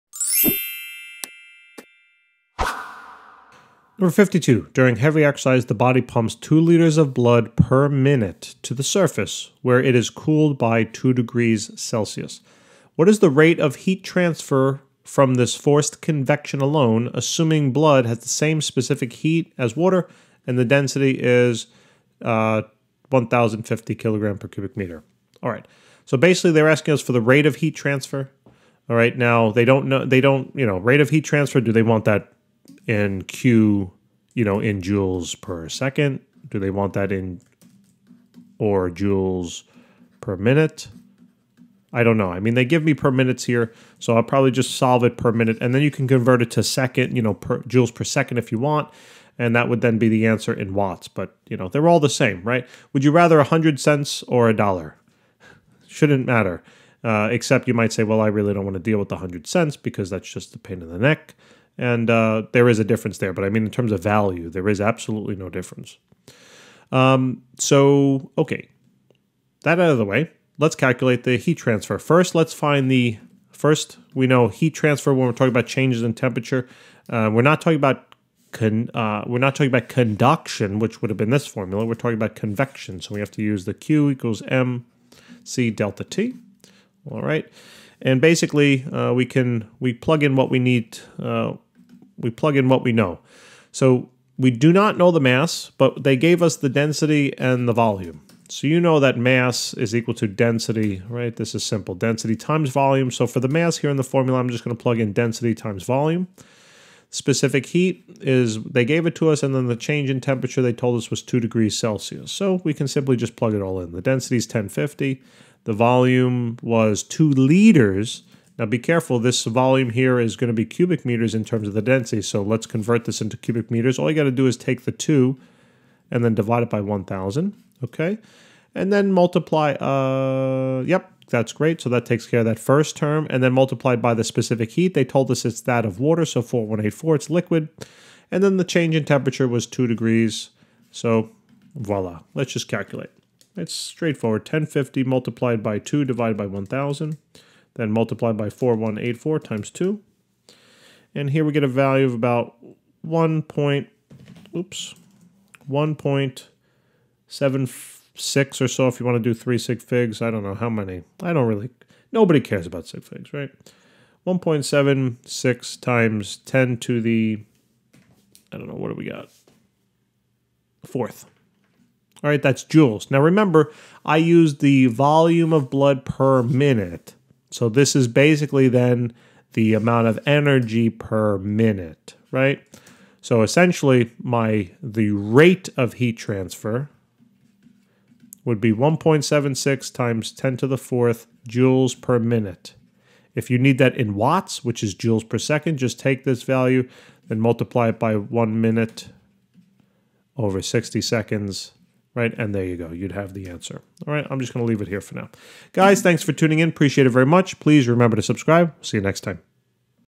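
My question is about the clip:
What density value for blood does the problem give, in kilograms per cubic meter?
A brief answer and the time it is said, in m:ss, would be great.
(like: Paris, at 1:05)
1,050, at 0:23.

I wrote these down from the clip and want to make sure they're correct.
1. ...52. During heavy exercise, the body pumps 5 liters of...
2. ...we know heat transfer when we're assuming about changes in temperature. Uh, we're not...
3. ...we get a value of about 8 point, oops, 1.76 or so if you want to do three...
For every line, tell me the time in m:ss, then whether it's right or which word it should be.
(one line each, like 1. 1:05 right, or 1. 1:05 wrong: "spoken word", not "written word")
1. 0:04 wrong: "2", not "5"
2. 1:14 wrong: "talking", not "assuming"
3. 2:31 wrong: "1", not "8".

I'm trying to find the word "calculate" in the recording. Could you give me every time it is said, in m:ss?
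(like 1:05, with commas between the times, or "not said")
1:10, 2:22.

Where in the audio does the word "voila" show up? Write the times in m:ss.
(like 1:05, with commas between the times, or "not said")
2:21.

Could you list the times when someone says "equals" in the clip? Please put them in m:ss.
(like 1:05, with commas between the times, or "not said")
1:24, 1:39.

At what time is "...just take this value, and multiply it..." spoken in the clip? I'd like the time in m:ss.
3:15.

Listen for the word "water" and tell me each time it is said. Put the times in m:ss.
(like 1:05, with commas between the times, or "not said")
0:19, 2:15.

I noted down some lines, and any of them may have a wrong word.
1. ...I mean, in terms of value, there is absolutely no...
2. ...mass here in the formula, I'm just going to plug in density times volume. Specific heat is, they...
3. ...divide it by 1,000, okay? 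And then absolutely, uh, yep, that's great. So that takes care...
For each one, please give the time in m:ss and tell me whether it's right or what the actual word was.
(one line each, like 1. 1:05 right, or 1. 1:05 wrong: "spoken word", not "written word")
1. 1:03 right
2. 1:43 right
3. 2:06 wrong: "multiply", not "absolutely".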